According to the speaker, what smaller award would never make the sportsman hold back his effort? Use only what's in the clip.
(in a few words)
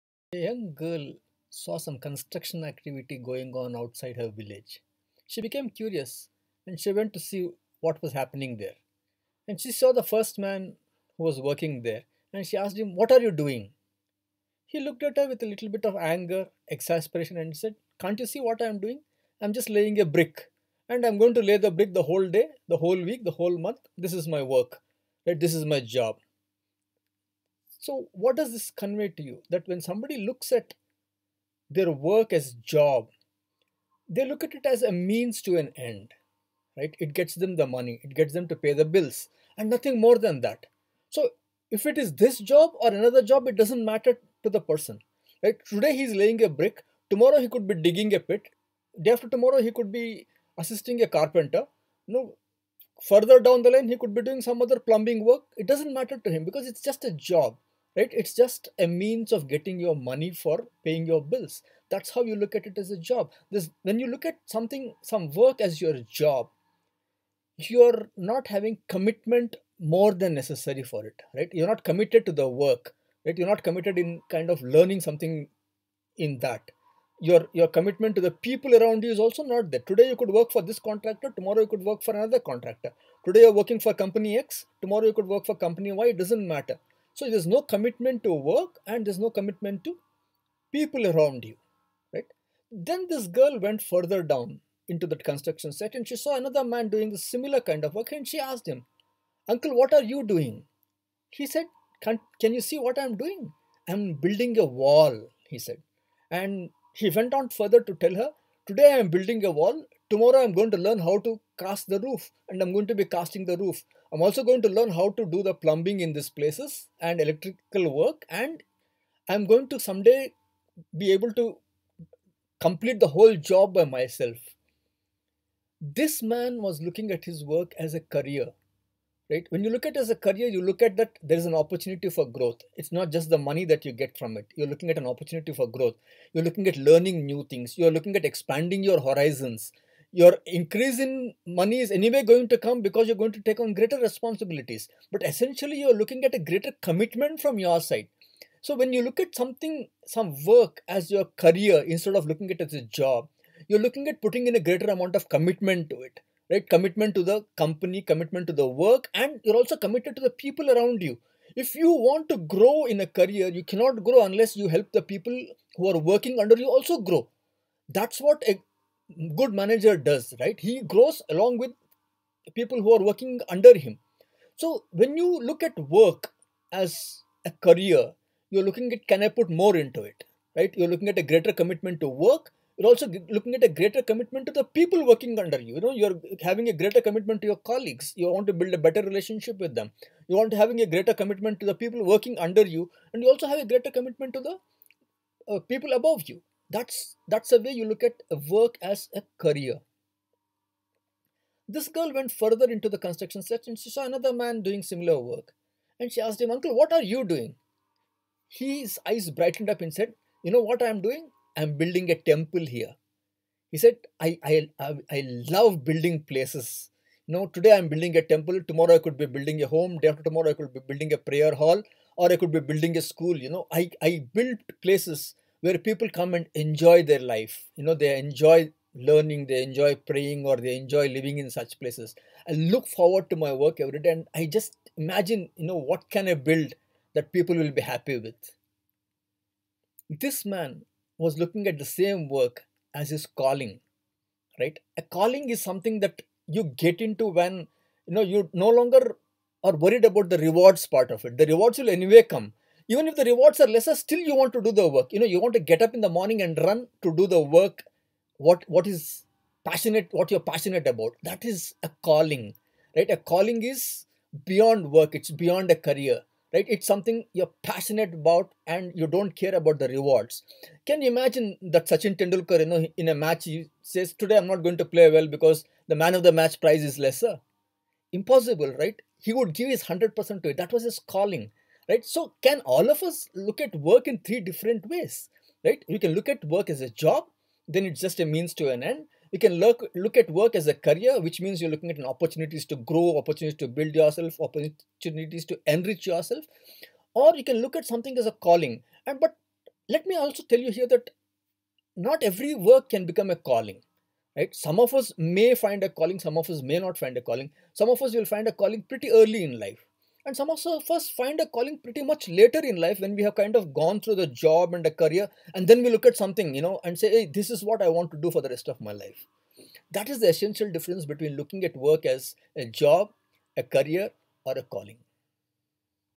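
man of the match prize.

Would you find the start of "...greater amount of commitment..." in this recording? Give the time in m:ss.
2:34.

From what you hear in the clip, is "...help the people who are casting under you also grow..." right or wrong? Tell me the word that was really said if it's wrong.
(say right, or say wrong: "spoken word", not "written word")
wrong: "working", not "casting".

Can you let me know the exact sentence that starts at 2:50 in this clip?
He grows along with people who are working under him.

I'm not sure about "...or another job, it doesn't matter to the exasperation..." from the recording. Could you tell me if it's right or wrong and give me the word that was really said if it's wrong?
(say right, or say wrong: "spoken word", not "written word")
wrong: "person", not "exasperation".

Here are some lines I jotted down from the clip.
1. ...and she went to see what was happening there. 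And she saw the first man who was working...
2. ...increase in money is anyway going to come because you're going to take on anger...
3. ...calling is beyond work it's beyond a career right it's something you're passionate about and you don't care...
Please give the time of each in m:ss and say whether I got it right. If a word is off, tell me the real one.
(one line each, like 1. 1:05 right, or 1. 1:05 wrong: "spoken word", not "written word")
1. 0:06 right
2. 2:20 wrong: "greater", not "anger"
3. 4:23 right.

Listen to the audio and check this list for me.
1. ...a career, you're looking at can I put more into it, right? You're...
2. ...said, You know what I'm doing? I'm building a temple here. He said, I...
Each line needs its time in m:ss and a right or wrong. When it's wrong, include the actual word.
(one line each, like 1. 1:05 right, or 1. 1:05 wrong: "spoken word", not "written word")
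1. 2:57 right
2. 3:29 right.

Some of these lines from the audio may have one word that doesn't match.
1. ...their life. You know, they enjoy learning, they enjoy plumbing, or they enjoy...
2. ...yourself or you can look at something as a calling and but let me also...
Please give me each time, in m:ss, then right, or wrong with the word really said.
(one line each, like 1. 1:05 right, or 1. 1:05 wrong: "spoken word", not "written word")
1. 3:47 wrong: "praying", not "plumbing"
2. 4:56 right.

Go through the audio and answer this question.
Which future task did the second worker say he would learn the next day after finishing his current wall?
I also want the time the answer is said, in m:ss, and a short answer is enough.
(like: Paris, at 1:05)
cast the roof, at 1:51.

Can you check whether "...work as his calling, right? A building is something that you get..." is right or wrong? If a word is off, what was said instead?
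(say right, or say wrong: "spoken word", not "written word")
wrong: "calling", not "building".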